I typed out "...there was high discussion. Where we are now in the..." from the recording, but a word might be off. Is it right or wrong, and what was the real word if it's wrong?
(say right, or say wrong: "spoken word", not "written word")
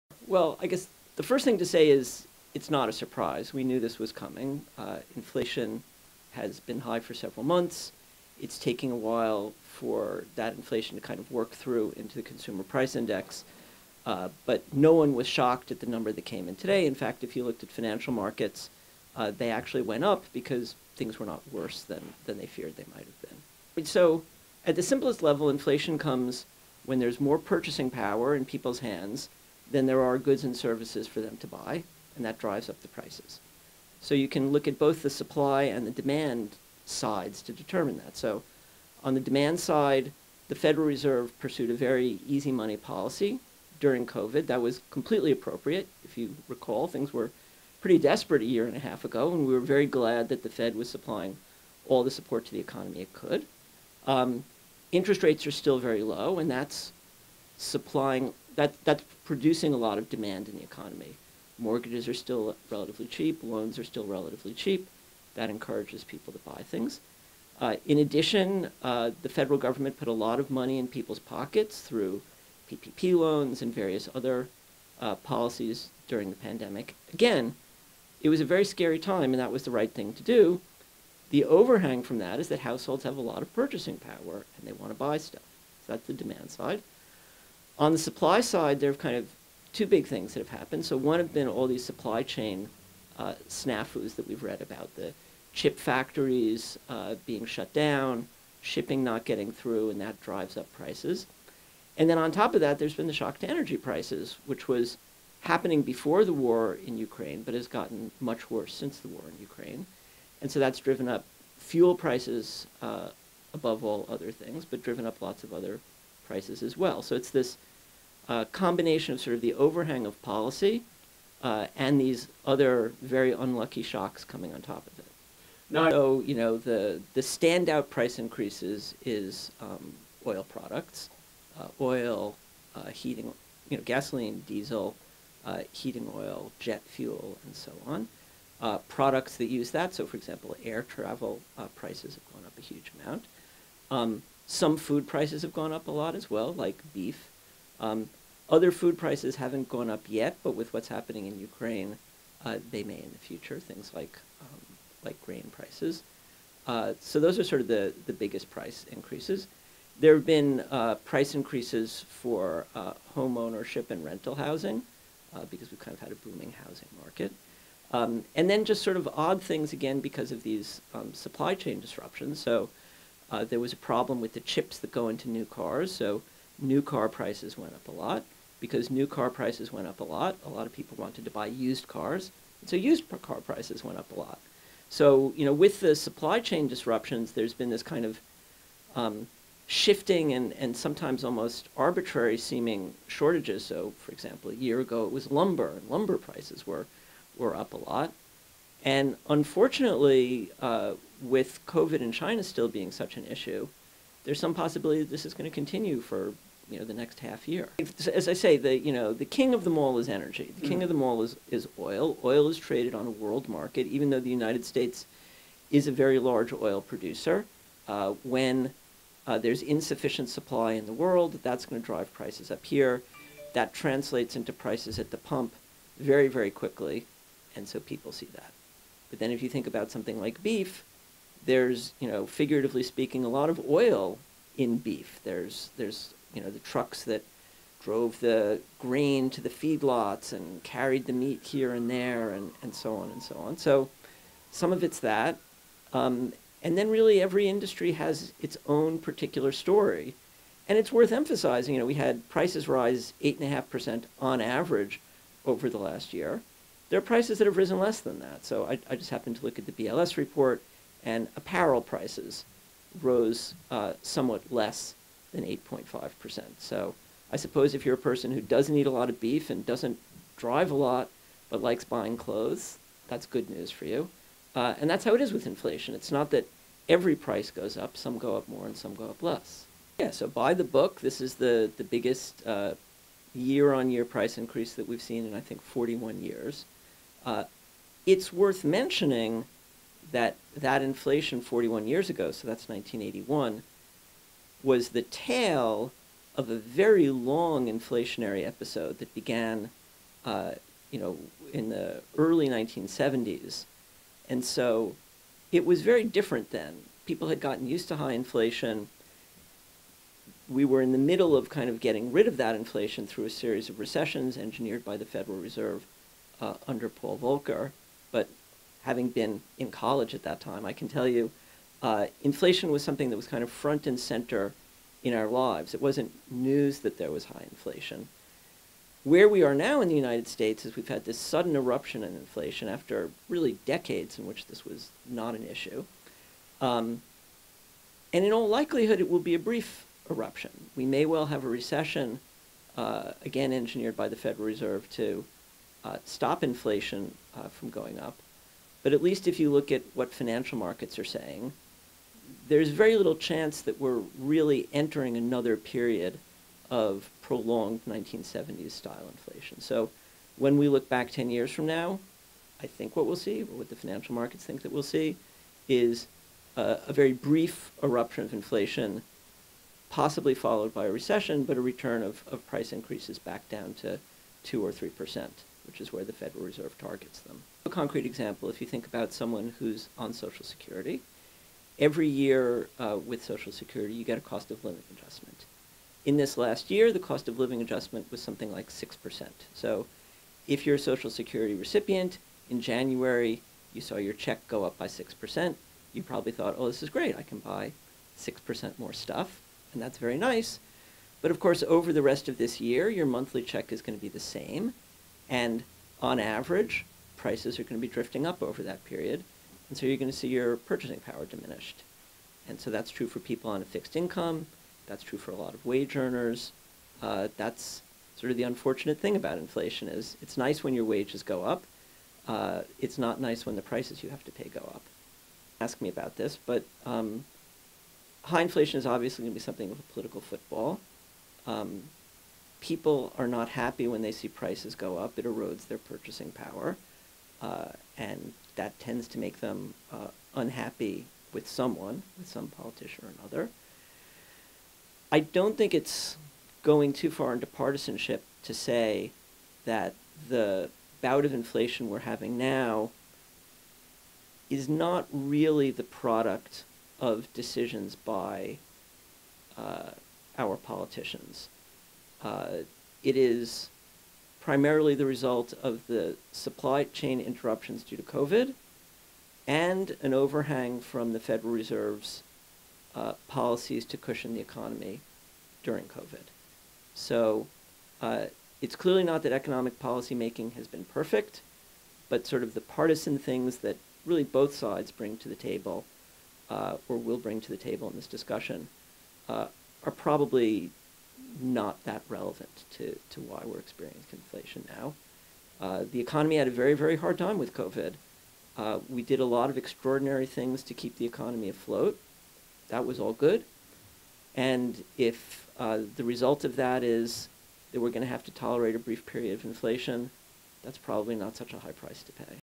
wrong: "inflation", not "discussion".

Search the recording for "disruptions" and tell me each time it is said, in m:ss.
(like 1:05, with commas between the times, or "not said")
2:51, 3:06.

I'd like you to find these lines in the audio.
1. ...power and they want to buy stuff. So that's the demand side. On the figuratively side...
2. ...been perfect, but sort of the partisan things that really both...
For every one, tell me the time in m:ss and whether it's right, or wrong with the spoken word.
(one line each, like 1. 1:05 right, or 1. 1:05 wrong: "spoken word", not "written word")
1. 1:23 wrong: "supply", not "figuratively"
2. 8:00 right.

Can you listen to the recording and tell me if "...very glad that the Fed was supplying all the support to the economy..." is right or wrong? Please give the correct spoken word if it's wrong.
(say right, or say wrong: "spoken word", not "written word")
right.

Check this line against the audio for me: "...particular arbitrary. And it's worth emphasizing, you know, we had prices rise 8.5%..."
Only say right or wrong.
wrong.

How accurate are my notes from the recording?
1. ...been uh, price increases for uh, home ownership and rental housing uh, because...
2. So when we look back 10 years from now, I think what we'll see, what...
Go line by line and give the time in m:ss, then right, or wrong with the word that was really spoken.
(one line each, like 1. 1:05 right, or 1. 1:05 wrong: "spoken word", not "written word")
1. 2:40 right
2. 5:59 right.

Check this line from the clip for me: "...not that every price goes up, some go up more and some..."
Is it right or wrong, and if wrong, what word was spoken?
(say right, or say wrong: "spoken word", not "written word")
right.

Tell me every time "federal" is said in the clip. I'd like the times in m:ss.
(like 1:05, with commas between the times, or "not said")
0:40, 1:09, 5:15, 5:44, 6:16, 7:51.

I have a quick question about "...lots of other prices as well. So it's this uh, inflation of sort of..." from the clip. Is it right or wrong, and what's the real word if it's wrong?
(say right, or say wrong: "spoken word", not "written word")
wrong: "combination", not "inflation".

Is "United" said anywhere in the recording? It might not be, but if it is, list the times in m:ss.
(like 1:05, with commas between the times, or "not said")
3:34, 5:29.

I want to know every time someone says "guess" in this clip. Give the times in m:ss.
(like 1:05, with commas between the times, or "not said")
0:00.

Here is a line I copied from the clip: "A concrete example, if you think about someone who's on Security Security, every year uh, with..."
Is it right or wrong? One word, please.
wrong.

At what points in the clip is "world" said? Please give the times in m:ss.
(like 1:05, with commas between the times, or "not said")
3:33, 3:40.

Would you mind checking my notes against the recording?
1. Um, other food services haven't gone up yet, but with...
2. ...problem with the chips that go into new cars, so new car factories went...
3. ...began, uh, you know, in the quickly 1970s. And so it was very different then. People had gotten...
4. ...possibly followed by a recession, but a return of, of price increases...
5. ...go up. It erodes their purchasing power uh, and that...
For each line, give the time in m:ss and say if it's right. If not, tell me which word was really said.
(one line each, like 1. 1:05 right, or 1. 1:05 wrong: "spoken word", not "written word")
1. 2:27 wrong: "prices", not "services"
2. 2:53 wrong: "prices", not "factories"
3. 4:59 wrong: "early", not "quickly"
4. 6:09 right
5. 7:14 right.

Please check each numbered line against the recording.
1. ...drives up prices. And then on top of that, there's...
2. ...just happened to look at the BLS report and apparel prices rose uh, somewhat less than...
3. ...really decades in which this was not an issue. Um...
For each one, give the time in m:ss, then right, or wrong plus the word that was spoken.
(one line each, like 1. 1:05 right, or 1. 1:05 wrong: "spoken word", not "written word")
1. 1:40 right
2. 4:18 right
3. 5:33 right.